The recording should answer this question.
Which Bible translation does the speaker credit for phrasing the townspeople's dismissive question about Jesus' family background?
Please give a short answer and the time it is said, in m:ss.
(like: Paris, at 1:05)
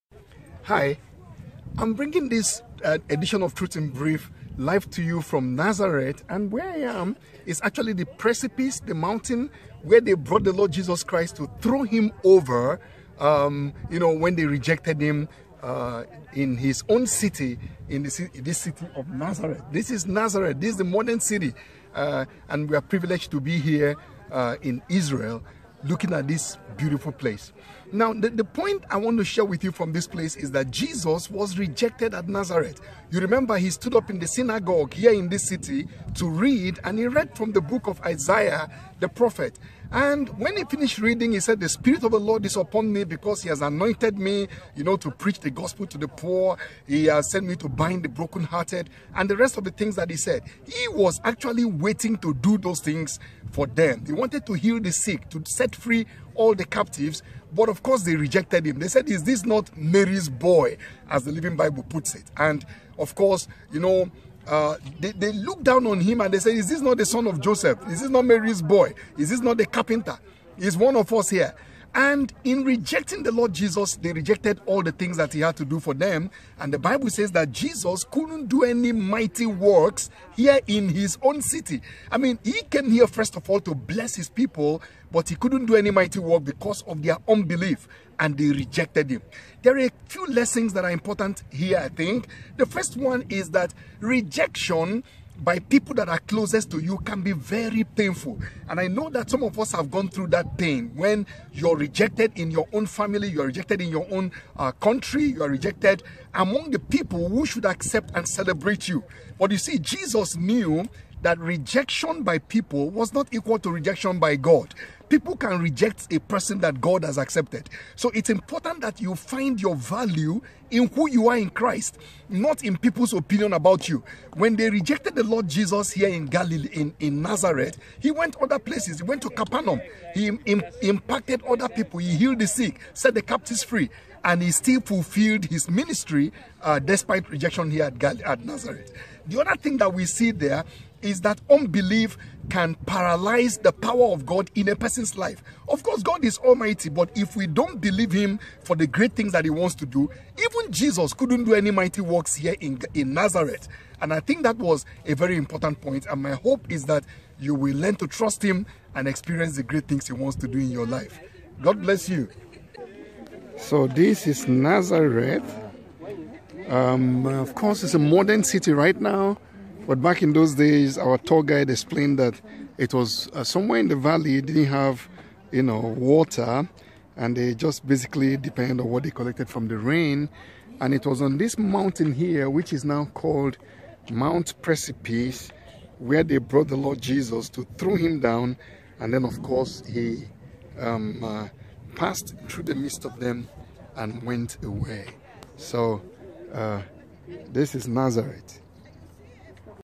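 The Living Bible, at 1:01.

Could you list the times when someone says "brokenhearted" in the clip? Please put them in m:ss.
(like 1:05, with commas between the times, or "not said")
0:48.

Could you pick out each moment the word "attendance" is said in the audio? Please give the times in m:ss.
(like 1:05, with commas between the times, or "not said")
not said.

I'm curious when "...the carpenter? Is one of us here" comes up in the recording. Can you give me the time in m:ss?
1:09.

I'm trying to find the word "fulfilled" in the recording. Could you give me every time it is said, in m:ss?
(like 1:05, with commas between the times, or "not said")
2:14.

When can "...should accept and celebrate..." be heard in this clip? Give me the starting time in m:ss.
1:47.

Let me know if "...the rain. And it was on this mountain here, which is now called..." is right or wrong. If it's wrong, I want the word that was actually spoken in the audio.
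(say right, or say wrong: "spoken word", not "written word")
right.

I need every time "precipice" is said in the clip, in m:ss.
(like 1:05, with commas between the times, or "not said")
0:08, 3:04.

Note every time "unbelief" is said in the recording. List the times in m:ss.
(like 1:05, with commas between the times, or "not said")
1:27, 2:21.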